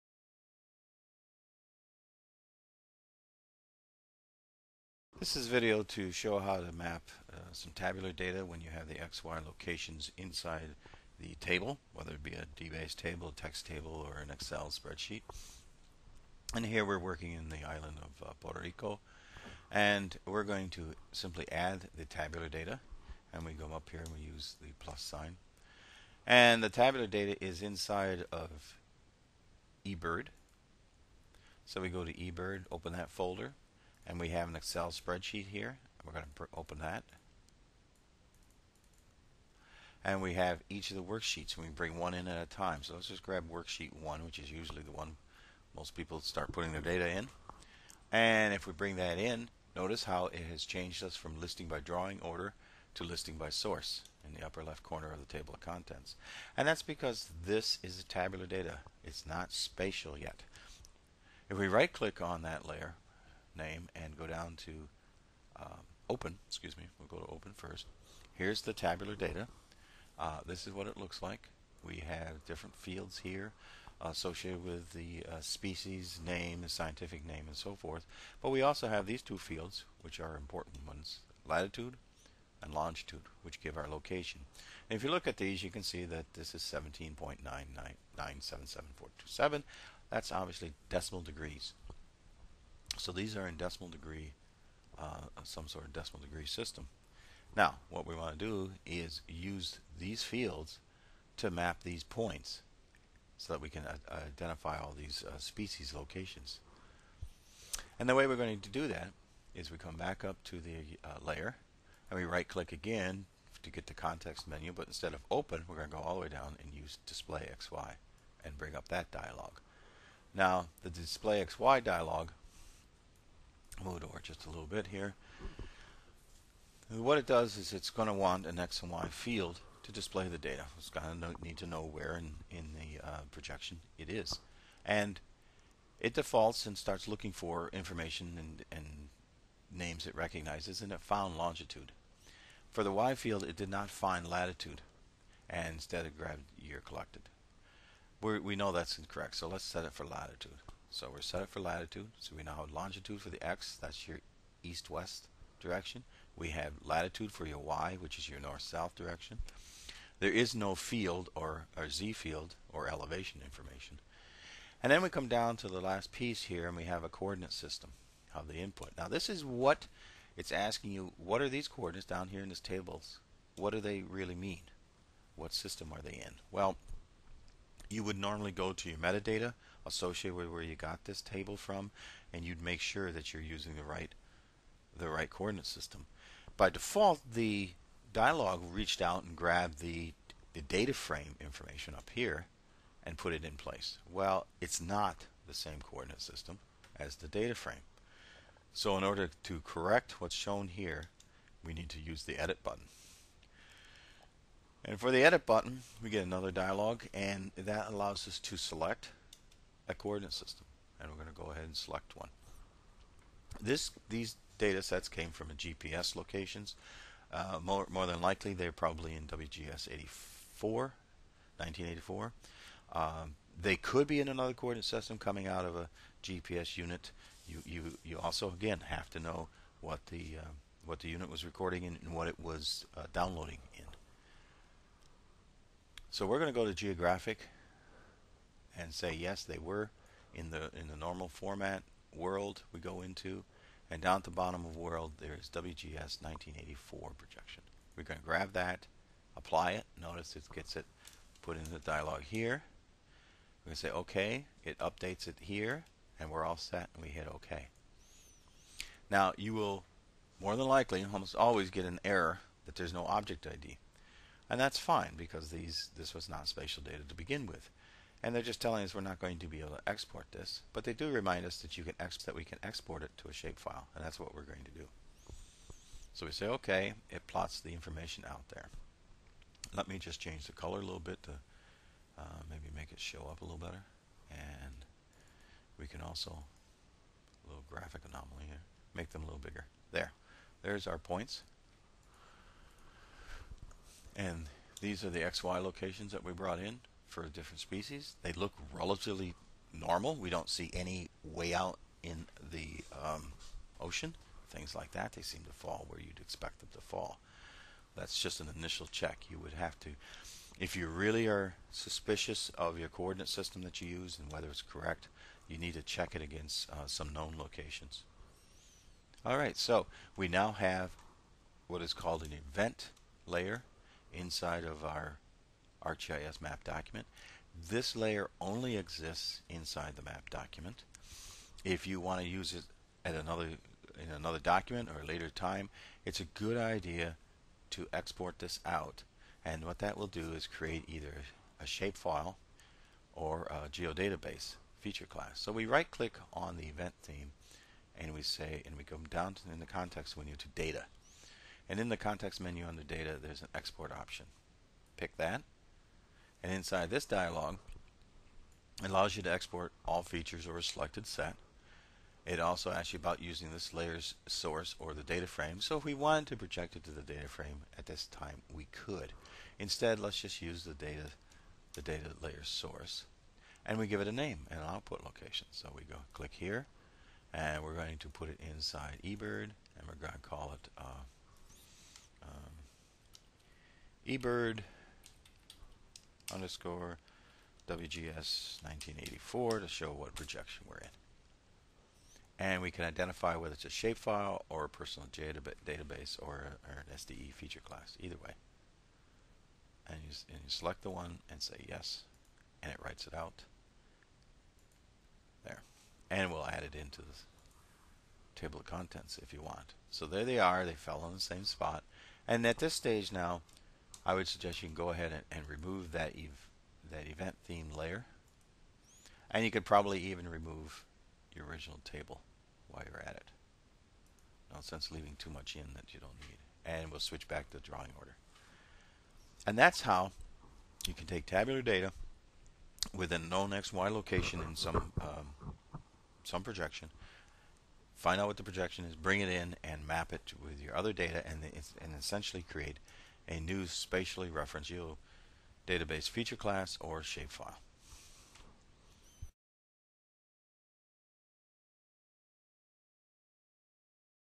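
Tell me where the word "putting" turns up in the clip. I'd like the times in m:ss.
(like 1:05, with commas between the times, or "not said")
0:46.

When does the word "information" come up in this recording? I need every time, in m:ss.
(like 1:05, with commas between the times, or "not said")
2:17, 2:43, 3:11, 4:37.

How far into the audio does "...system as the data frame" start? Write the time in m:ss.
3:16.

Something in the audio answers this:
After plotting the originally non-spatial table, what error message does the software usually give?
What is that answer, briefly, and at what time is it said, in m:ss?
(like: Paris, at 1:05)
no object ID, at 4:22.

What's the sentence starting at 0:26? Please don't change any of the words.
And the tabular data is inside of eBird.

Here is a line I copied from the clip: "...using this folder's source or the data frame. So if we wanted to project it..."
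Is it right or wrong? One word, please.
wrong.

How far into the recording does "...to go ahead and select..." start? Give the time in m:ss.
3:31.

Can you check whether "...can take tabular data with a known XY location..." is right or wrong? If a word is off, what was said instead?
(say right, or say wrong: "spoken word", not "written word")
right.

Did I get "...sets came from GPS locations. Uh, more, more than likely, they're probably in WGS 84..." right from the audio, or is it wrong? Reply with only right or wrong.
right.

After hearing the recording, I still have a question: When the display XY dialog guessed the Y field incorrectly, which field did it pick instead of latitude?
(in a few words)
year collected.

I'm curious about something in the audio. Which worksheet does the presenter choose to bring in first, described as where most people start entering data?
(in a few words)
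worksheet one.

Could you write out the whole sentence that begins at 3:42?
Um, they could be in another coordinate system coming out of a GPS unit.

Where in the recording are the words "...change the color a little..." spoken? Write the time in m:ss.
4:40.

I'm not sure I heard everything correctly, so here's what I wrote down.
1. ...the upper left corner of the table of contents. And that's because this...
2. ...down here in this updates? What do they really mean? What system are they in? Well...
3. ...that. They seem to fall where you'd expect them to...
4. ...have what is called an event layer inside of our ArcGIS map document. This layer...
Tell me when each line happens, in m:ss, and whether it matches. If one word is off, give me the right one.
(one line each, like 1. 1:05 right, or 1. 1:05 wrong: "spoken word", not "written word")
1. 0:54 right
2. 2:52 wrong: "tables", not "updates"
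3. 5:04 right
4. 5:20 right.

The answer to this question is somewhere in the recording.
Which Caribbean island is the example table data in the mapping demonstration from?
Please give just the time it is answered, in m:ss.
0:18.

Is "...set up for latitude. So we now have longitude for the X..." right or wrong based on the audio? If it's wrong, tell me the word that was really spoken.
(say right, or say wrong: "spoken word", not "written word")
right.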